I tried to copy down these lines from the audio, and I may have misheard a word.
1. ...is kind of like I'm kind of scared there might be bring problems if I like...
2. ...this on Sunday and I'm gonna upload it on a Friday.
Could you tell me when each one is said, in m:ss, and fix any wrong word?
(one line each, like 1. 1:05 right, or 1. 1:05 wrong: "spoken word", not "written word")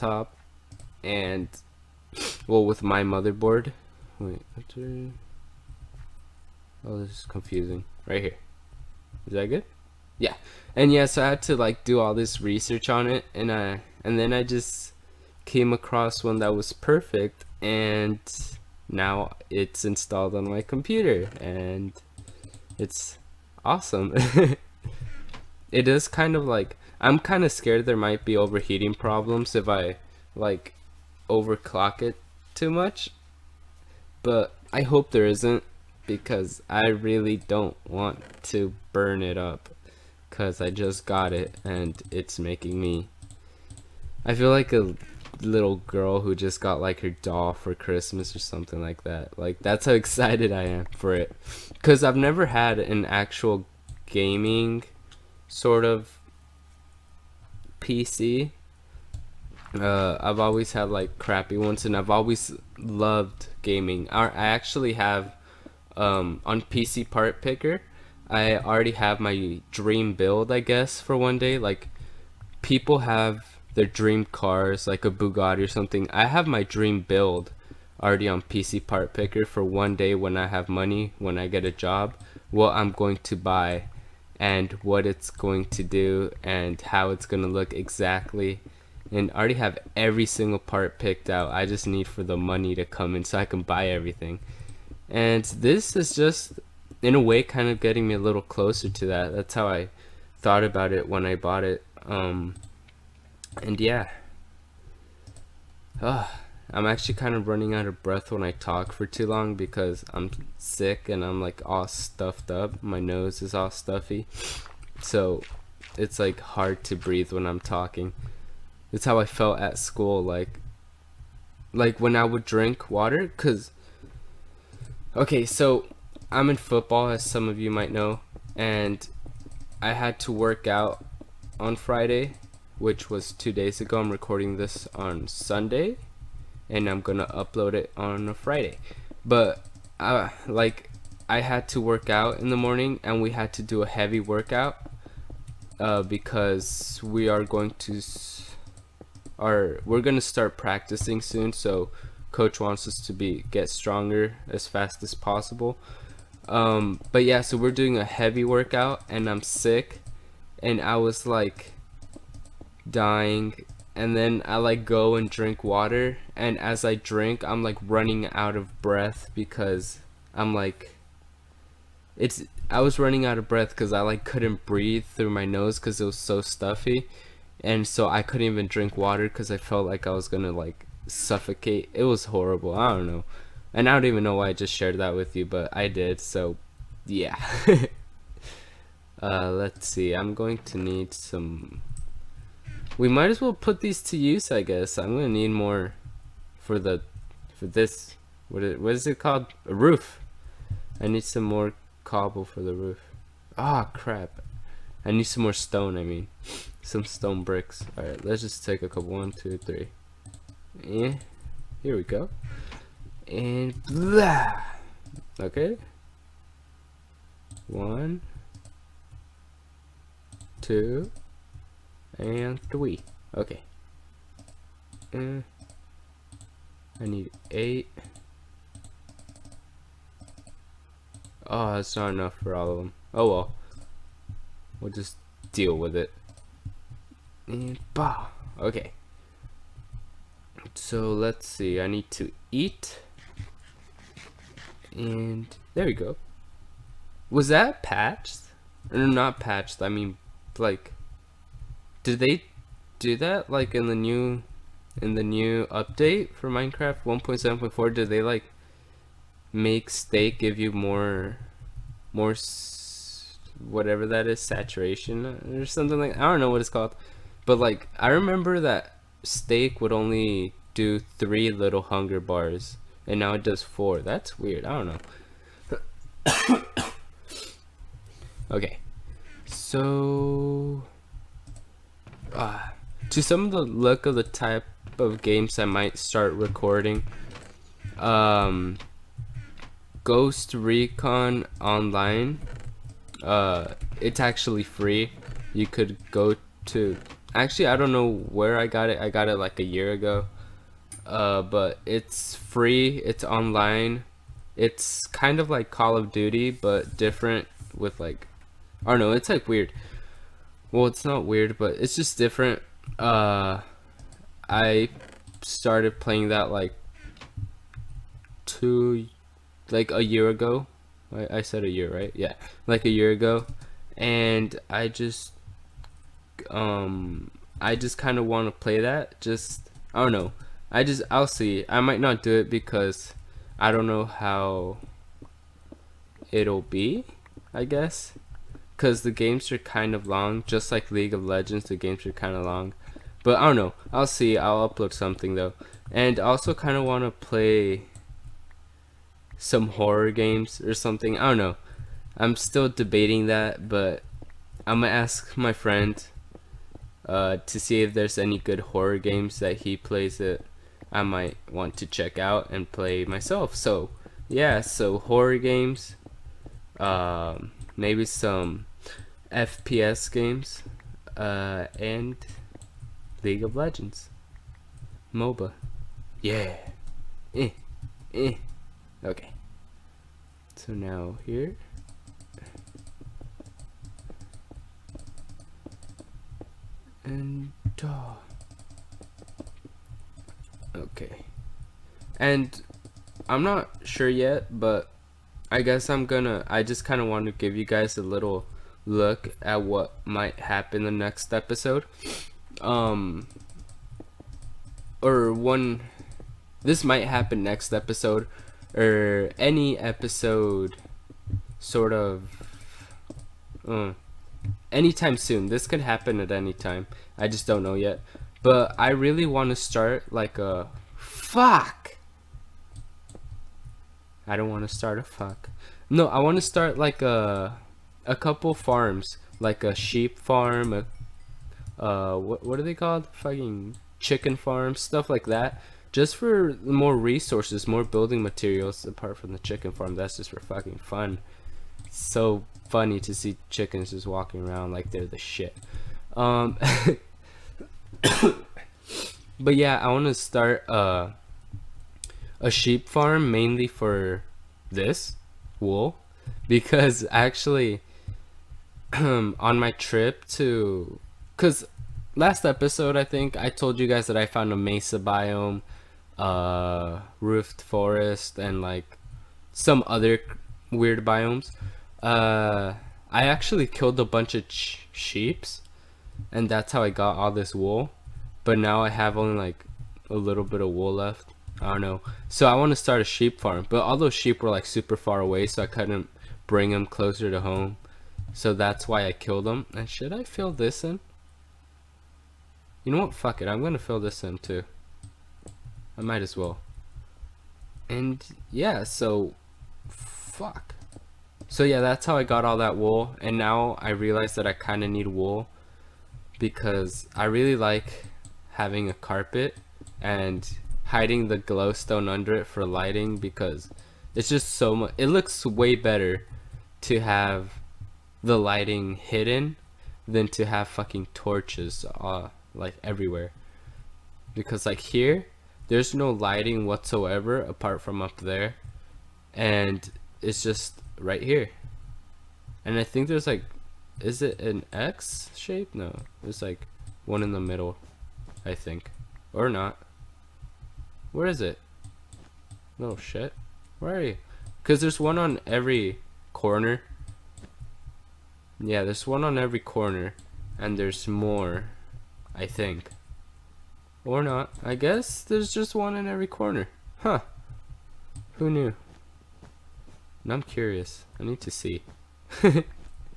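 1. 0:25 wrong: "overheating", not "bring"
2. 2:14 right.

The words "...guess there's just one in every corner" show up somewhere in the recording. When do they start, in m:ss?
9:14.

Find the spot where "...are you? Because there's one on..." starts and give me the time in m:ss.
9:03.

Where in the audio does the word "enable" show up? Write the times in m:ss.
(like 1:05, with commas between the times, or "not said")
not said.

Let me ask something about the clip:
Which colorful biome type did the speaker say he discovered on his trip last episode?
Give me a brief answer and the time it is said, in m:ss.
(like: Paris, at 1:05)
mesa biome, at 7:44.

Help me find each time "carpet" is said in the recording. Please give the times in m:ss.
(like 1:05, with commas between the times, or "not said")
8:28.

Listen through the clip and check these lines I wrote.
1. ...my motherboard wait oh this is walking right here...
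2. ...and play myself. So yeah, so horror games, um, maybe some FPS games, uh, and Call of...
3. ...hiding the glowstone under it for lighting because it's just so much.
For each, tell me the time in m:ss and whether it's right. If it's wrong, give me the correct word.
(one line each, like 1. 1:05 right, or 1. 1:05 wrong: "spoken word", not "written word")
1. 0:02 wrong: "confusing", not "walking"
2. 6:02 wrong: "League", not "Call"
3. 8:30 right.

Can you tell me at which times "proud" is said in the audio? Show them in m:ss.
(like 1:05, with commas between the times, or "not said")
not said.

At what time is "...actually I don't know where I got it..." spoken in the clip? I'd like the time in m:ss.
4:57.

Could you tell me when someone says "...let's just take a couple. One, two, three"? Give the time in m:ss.
3:28.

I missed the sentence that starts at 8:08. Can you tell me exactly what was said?
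So that's why I killed them.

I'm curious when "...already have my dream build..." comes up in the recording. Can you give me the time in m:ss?
1:08.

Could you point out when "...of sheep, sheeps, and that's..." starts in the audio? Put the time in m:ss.
7:54.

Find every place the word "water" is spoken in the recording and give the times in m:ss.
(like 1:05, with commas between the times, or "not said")
2:02, 2:45, 2:58.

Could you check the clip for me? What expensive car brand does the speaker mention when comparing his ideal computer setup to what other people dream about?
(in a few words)
Bugatti.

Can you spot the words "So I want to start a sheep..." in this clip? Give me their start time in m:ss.
8:02.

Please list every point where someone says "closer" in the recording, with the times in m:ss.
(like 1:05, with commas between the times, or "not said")
1:38, 8:06.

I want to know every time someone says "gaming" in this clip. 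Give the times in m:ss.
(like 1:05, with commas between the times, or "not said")
0:54, 1:03.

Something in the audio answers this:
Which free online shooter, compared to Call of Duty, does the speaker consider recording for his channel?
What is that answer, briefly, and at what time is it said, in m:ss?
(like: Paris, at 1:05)
Ghost Recon Online, at 4:50.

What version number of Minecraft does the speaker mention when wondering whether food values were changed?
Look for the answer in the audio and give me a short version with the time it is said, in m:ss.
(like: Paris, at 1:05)
1.7.4, at 4:17.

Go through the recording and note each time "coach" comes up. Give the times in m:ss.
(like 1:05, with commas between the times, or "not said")
2:32.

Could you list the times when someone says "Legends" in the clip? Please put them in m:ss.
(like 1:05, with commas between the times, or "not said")
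5:41, 6:13.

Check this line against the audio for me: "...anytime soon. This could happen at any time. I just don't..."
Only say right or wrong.
right.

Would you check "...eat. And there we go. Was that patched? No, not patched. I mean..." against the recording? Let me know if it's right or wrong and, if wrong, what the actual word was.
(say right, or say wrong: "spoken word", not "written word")
right.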